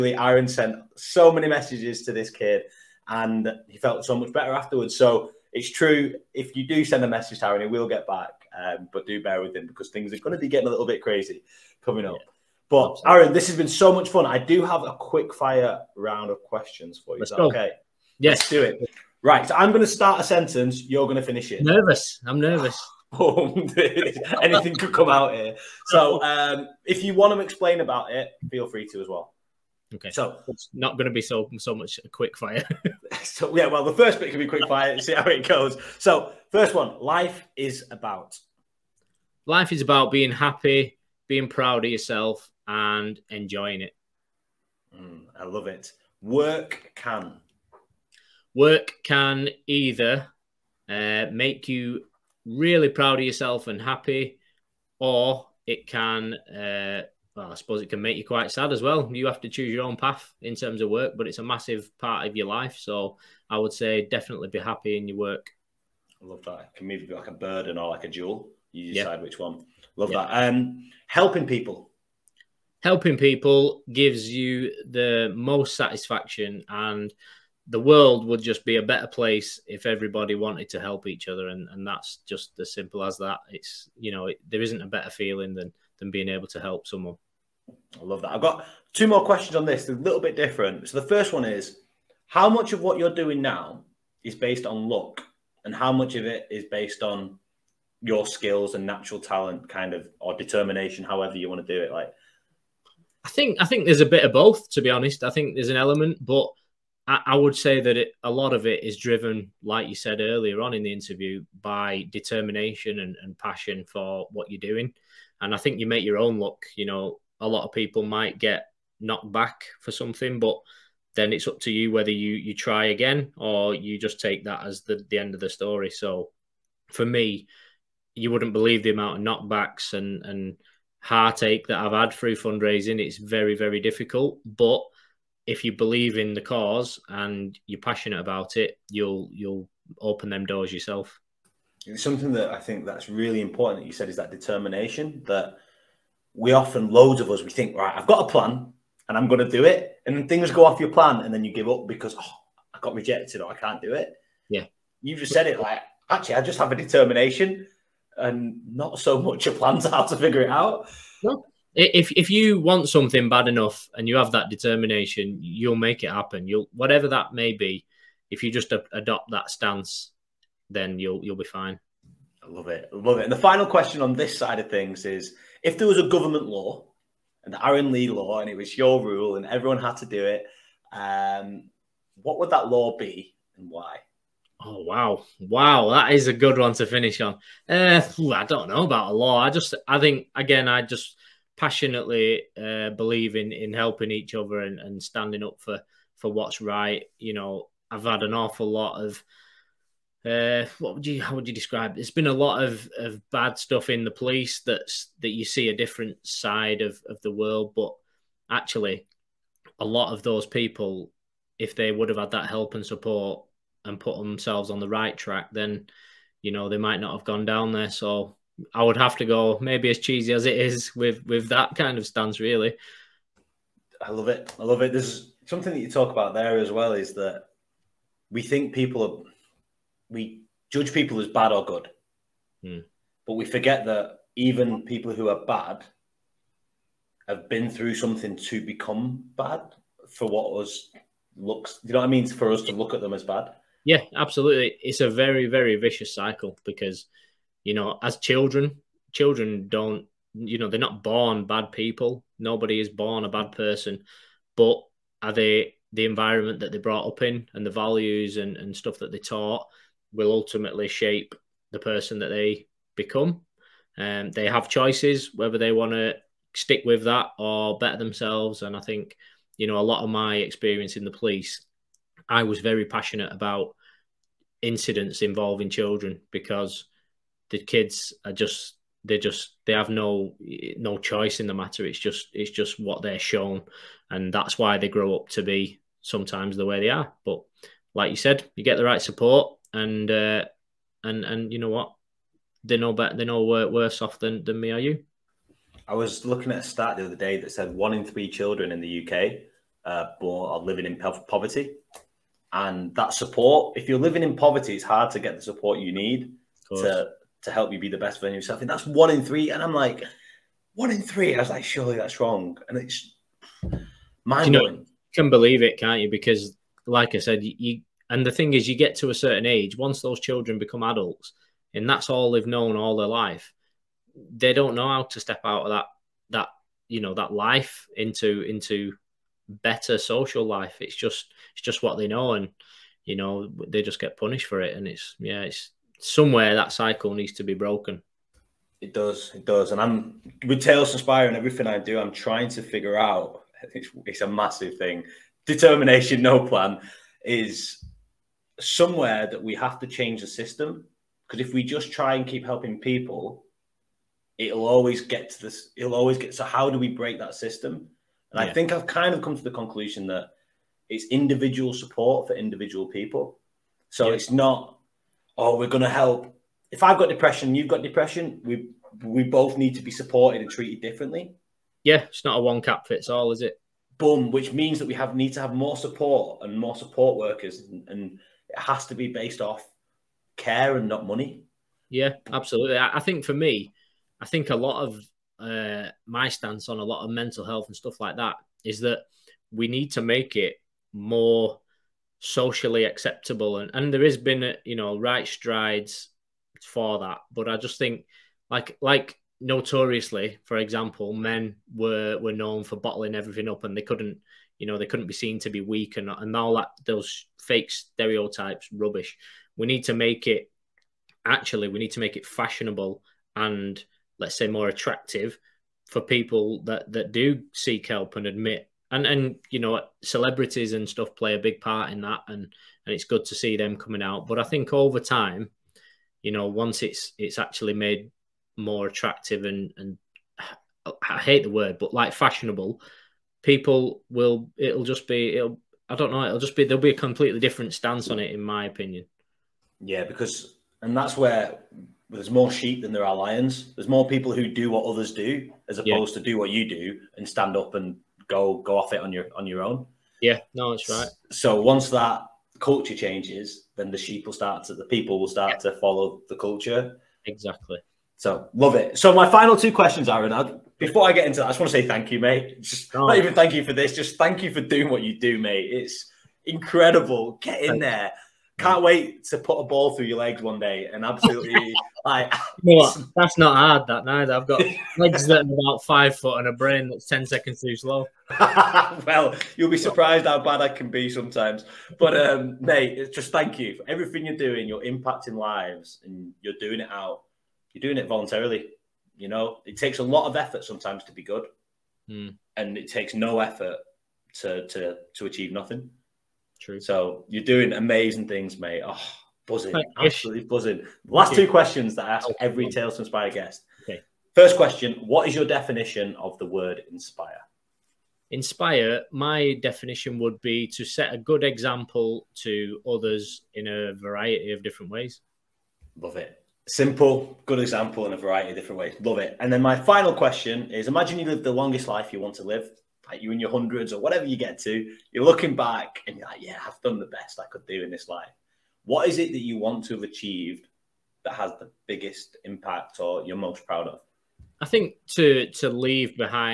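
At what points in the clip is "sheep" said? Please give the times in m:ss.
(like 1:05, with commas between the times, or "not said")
7:22, 7:33.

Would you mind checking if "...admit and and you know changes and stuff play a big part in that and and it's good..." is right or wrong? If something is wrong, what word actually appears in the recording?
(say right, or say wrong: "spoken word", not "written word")
wrong: "celebrities", not "changes".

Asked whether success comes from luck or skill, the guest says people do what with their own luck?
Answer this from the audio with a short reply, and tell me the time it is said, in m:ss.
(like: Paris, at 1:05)
make your own luck, at 1:55.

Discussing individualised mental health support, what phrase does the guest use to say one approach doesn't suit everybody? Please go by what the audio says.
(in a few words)
one cap fits all.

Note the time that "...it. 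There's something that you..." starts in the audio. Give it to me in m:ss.
3:44.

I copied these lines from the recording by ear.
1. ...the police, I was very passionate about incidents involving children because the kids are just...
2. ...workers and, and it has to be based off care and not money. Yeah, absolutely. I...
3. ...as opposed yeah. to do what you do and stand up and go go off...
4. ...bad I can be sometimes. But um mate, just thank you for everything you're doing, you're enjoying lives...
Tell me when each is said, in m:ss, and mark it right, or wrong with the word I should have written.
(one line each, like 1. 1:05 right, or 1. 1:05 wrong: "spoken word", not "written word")
1. 4:31 right
2. 6:17 right
3. 7:25 right
4. 8:00 wrong: "impacting", not "enjoying".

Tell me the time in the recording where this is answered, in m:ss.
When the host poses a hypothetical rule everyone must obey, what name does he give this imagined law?
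2:57.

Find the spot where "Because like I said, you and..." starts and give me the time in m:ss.
5:16.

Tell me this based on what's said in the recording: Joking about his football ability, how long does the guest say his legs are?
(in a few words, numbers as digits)
about 5 foot.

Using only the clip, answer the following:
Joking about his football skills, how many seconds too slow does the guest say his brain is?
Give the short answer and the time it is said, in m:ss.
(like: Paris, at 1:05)
10, at 7:57.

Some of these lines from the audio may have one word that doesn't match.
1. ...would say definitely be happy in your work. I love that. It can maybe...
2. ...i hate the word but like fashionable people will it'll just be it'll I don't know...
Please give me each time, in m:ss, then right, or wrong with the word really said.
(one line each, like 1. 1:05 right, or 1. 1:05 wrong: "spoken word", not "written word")
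1. 1:03 right
2. 7:11 right.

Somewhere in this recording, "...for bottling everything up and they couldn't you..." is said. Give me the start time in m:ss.
6:42.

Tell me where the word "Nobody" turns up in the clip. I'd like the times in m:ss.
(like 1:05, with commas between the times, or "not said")
4:12.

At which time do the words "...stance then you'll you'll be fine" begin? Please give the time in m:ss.
2:49.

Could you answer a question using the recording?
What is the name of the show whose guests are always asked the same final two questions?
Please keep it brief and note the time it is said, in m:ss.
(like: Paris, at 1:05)
Tales to Inspire, at 8:22.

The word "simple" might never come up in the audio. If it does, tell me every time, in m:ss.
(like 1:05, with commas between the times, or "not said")
1:22, 8:36.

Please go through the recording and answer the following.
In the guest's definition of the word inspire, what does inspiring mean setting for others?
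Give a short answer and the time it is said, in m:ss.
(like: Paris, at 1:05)
a good example, at 8:31.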